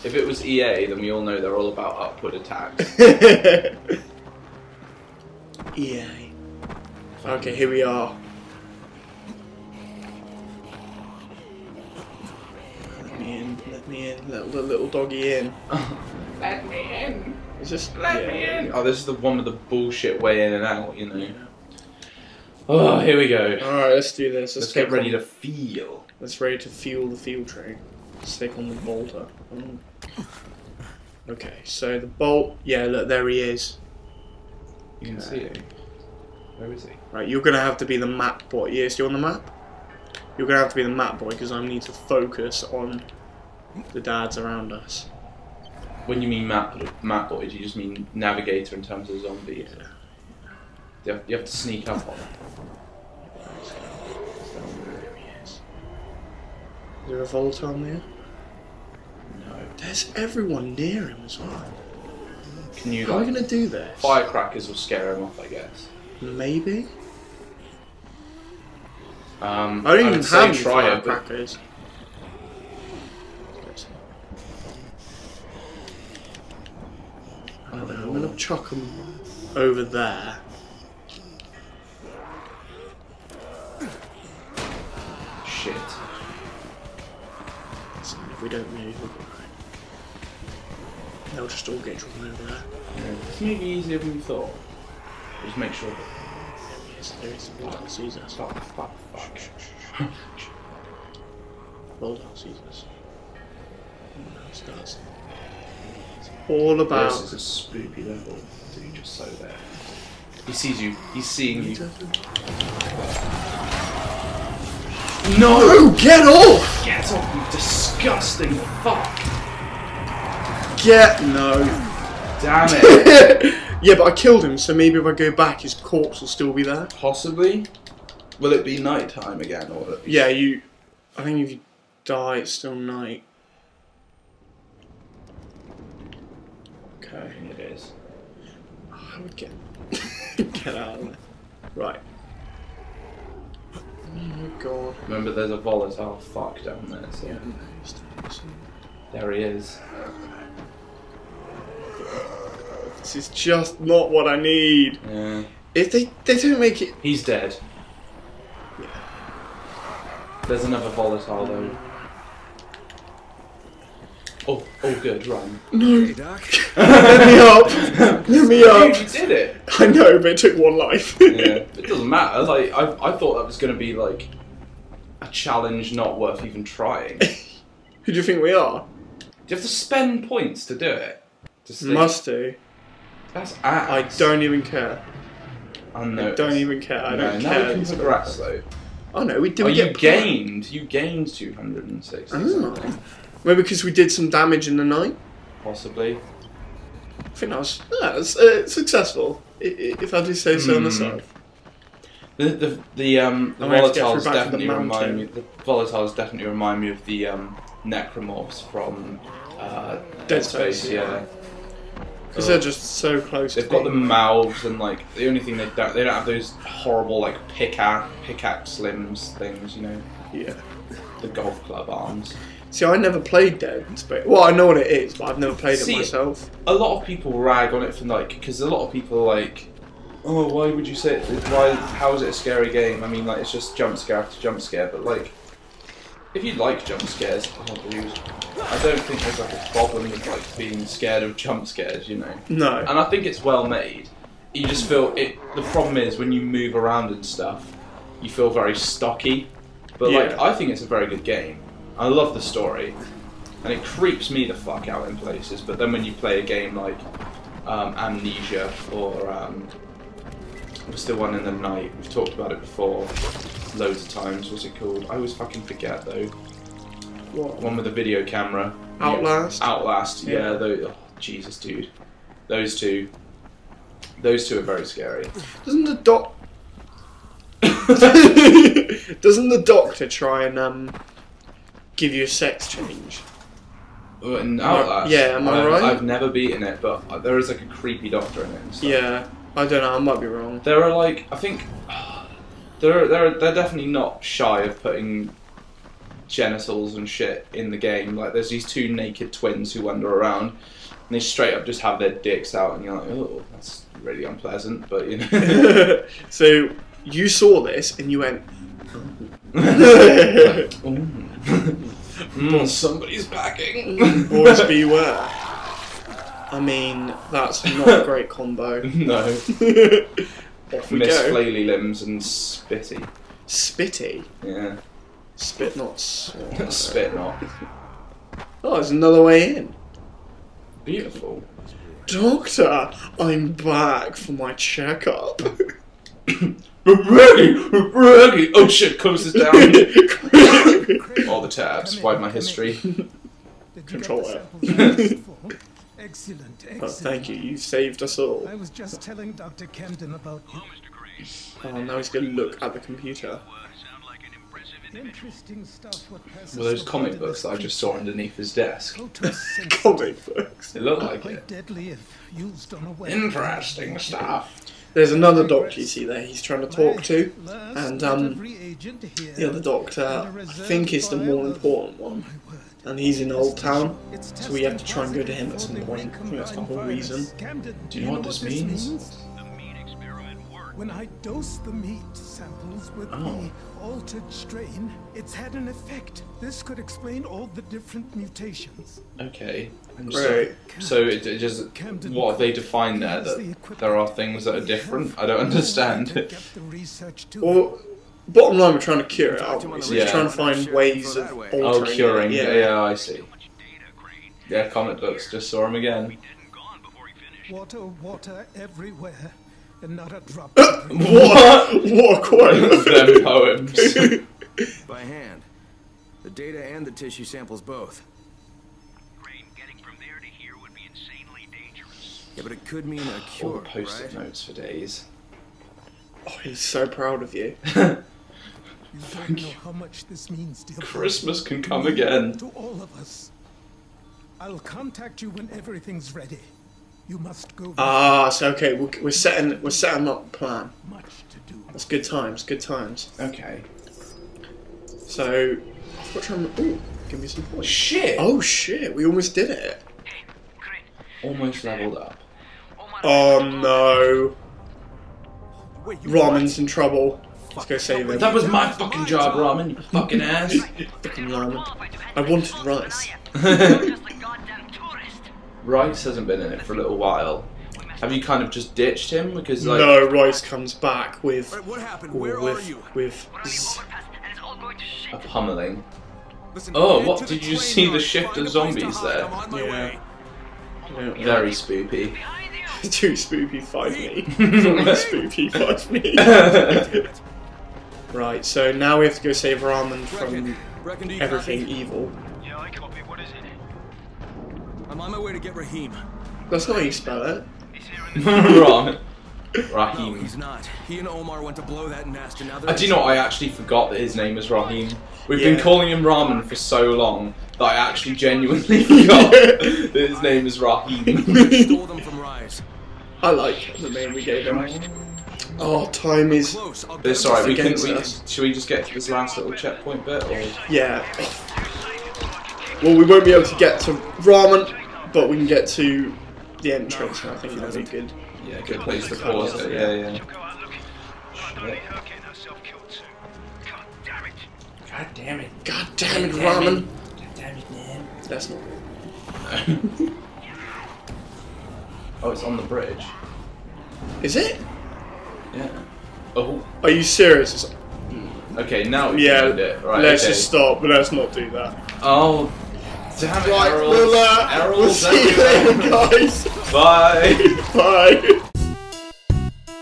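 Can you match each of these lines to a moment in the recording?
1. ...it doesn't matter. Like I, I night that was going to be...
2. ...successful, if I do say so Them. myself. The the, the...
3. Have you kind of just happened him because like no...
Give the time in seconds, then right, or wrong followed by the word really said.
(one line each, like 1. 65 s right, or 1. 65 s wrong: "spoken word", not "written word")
1. 171 s wrong: "thought", not "night"
2. 198 s wrong: "Hmm", not "Them"
3. 467 s wrong: "ditched", not "happened".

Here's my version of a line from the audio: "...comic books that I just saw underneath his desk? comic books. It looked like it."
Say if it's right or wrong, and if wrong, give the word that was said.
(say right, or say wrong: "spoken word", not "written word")
right.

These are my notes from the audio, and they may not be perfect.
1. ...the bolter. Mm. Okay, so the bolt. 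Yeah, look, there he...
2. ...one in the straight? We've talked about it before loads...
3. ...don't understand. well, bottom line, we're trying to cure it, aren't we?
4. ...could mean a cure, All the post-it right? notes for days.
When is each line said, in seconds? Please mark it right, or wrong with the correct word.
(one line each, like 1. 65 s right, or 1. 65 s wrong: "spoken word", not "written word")
1. 28 s right
2. 261 s wrong: "night", not "straight"
3. 395 s right
4. 422 s right.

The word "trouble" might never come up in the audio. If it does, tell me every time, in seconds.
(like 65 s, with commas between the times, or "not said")
456 s.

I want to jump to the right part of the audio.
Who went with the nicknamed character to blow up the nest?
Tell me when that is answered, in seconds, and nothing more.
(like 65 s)
501 s.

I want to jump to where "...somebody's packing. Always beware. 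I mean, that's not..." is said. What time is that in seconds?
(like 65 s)
312 s.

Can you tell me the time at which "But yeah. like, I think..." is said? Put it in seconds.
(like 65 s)
249 s.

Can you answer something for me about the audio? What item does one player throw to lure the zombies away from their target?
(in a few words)
firecrackers.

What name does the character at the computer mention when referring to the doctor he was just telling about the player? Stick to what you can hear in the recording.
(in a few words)
Dr. Camden.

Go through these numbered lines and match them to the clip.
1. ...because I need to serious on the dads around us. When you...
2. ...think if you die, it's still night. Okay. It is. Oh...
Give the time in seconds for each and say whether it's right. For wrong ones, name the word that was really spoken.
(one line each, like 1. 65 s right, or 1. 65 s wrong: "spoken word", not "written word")
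1. 41 s wrong: "focus", not "serious"
2. 131 s right.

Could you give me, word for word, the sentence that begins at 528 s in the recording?
Yeah, good place to pause it.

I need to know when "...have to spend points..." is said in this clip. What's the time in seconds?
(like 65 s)
179 s.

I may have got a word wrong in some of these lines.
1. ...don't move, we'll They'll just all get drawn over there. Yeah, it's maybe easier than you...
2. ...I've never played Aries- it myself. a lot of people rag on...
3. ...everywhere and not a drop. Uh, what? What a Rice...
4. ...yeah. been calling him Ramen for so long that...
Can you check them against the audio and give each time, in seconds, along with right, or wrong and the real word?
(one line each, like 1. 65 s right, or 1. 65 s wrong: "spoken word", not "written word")
1. 88 s right
2. 225 s wrong: "See", not "Aries"
3. 408 s wrong: "Them", not "Rice"
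4. 505 s right.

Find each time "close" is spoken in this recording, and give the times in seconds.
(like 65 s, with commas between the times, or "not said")
213 s, 338 s.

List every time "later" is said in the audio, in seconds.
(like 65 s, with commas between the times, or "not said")
555 s.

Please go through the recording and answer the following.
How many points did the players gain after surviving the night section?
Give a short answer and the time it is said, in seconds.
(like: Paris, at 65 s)
260, at 191 s.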